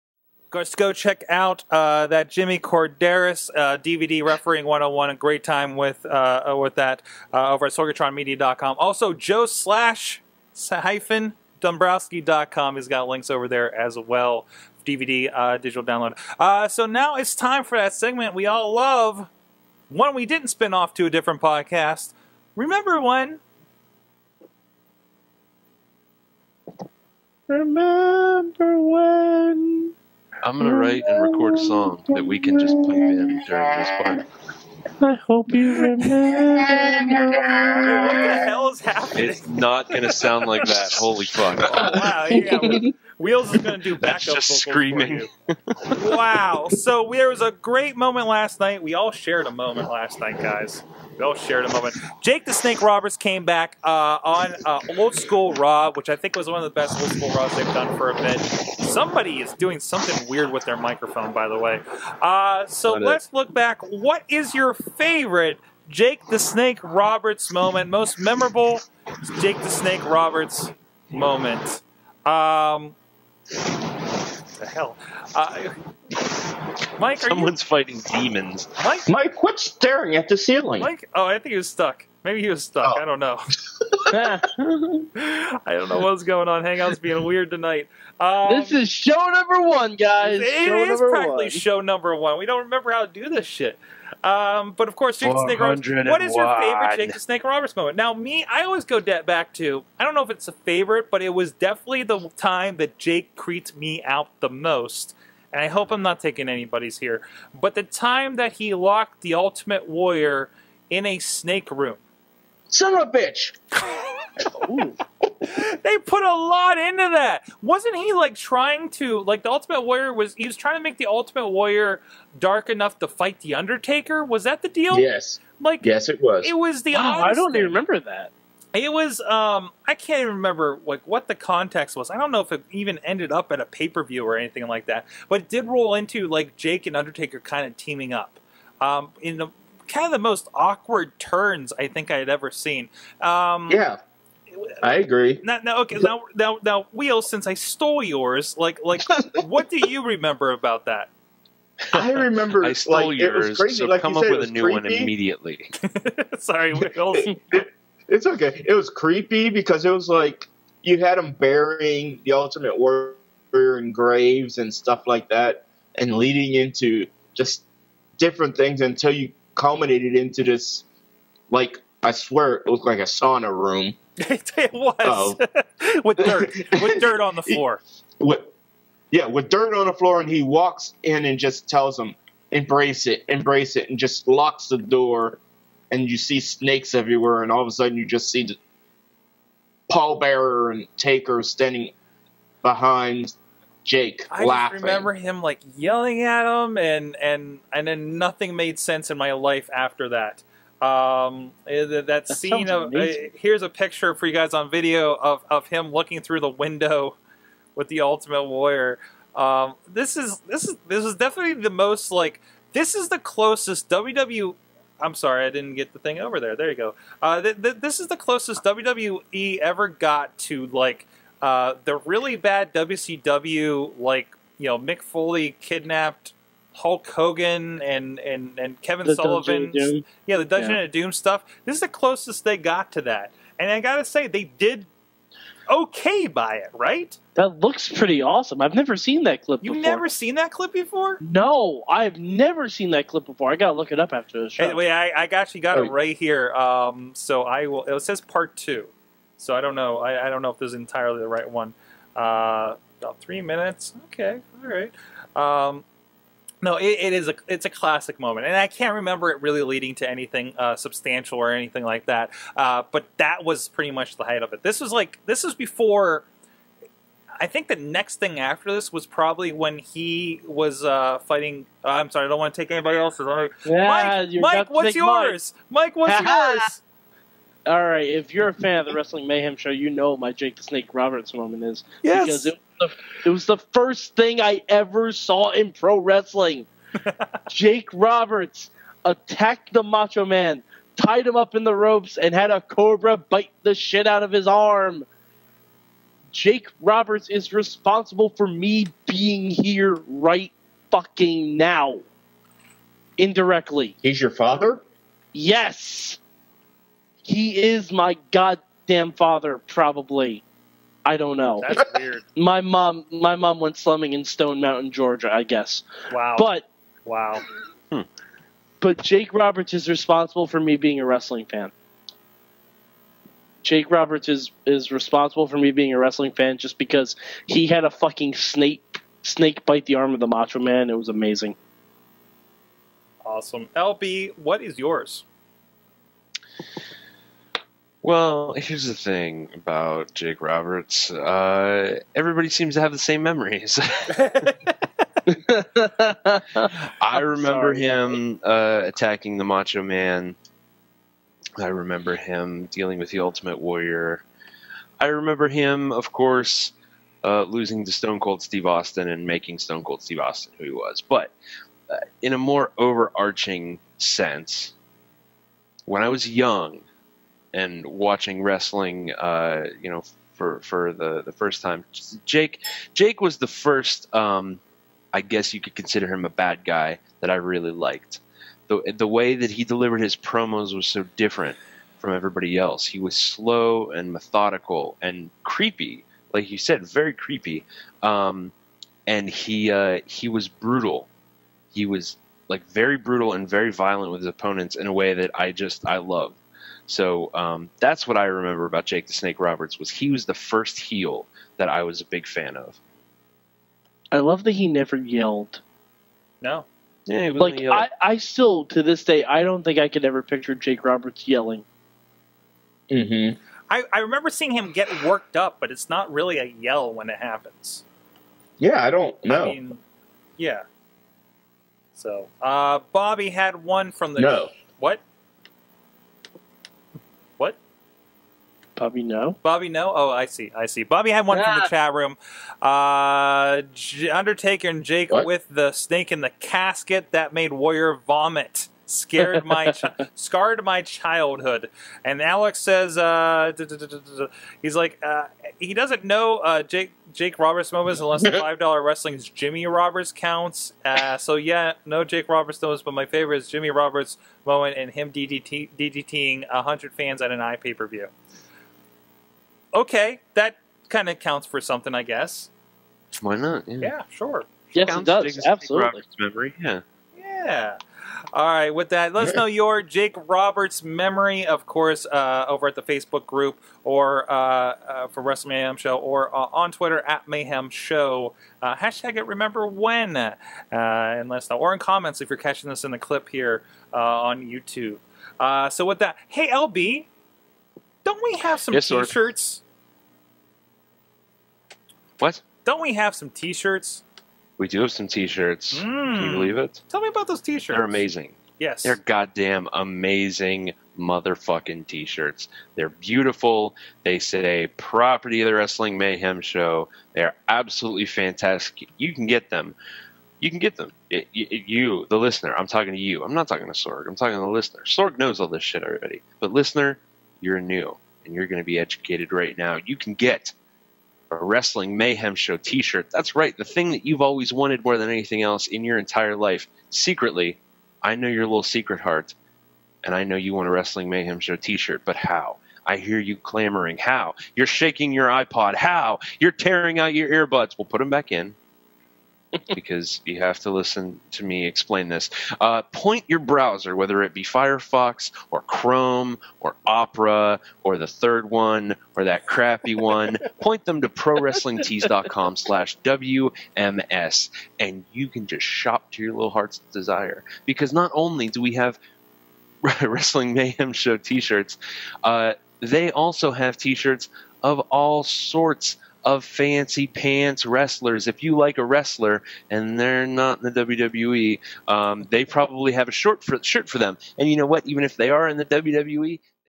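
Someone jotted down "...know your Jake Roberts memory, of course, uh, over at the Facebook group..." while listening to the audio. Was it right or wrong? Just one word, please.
right.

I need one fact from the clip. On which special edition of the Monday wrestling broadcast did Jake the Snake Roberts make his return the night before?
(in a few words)
Old School Raw.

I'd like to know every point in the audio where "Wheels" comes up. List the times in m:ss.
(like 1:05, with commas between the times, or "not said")
0:43, 2:26.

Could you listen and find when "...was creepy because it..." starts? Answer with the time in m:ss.
2:38.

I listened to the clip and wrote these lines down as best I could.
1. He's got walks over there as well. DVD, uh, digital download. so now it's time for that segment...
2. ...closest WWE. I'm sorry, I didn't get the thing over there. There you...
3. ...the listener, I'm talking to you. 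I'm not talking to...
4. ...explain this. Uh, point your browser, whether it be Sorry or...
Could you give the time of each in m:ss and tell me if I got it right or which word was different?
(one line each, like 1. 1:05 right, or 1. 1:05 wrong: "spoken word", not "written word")
1. 0:12 wrong: "links", not "walks"
2. 3:33 right
3. 8:32 right
4. 9:01 wrong: "Firefox", not "Sorry".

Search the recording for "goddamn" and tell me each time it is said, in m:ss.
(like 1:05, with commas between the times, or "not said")
5:08, 8:18.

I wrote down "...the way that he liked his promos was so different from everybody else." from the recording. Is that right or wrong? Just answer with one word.
wrong.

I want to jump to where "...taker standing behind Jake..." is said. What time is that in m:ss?
3:10.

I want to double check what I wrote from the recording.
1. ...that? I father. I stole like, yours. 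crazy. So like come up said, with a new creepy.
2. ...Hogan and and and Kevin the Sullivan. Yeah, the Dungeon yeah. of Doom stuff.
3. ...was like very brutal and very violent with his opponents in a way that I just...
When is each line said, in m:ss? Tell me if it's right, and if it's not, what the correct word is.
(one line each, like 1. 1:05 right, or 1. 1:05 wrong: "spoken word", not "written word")
1. 2:30 wrong: "remember", not "father"
2. 3:47 right
3. 6:31 right.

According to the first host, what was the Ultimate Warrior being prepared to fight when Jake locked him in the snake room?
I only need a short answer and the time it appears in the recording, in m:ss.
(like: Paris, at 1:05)
the Undertaker, at 2:03.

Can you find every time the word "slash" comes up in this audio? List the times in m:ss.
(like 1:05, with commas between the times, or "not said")
0:09, 9:12.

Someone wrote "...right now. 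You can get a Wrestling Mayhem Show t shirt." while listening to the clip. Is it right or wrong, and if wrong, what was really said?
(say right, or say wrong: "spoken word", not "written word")
right.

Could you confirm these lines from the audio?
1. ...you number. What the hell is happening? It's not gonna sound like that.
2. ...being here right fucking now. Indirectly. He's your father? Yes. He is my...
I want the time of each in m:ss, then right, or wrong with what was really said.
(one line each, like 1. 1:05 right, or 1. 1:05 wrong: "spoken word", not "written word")
1. 0:35 wrong: "remember", not "number"
2. 4:59 right.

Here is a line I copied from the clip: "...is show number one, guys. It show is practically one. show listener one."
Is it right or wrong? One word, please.
wrong.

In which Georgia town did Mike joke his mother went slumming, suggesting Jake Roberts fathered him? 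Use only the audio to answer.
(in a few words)
Stone Mountain.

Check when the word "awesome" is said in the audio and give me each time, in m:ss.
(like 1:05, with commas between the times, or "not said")
3:58, 5:33.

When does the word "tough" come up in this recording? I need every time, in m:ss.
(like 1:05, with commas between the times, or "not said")
not said.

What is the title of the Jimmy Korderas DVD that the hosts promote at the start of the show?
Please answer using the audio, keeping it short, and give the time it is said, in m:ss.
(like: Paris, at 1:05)
Refereeing 101, at 0:04.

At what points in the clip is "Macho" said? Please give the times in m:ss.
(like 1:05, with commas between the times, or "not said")
4:49, 5:30, 5:49.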